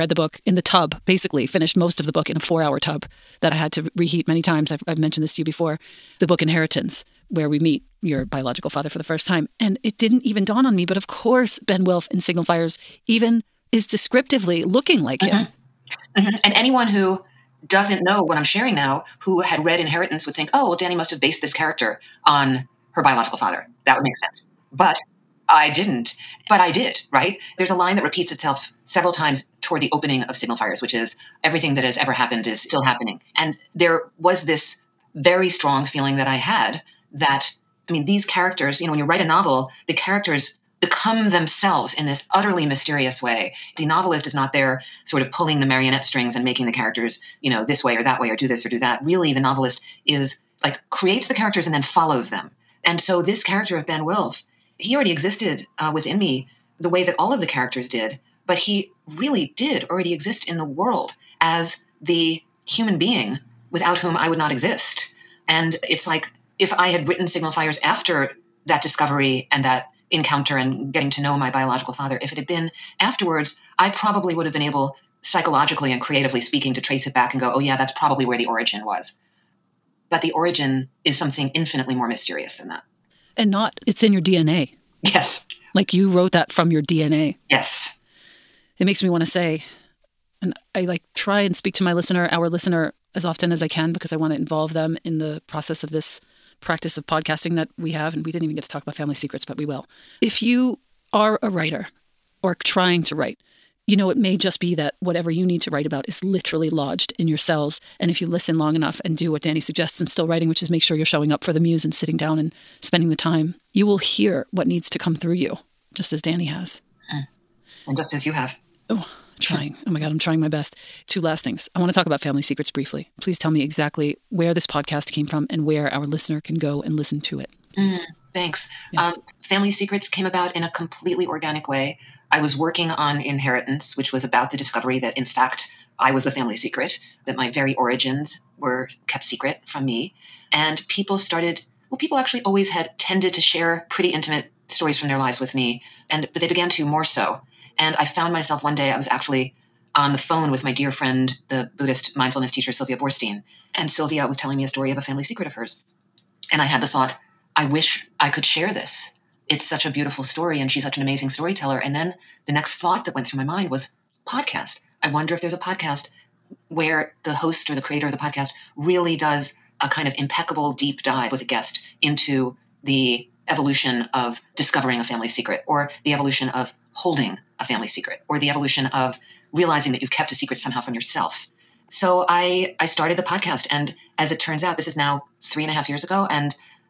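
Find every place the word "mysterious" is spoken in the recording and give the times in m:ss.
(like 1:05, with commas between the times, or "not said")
0:42, 1:22.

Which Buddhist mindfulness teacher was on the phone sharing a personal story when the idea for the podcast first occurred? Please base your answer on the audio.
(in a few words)
Sylvia Boorstein.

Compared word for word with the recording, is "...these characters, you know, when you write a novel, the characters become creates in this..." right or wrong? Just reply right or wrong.
wrong.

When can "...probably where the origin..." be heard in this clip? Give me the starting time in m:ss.
1:17.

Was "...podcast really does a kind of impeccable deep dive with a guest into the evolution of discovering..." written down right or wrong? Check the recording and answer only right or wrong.
right.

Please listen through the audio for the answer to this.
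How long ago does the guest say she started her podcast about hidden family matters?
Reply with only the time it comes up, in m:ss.
3:05.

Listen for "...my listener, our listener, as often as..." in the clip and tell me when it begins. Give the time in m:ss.
1:31.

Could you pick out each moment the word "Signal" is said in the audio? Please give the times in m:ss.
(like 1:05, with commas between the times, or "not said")
0:12, 0:30, 1:07.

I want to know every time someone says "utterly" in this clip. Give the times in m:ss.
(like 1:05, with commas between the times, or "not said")
0:42.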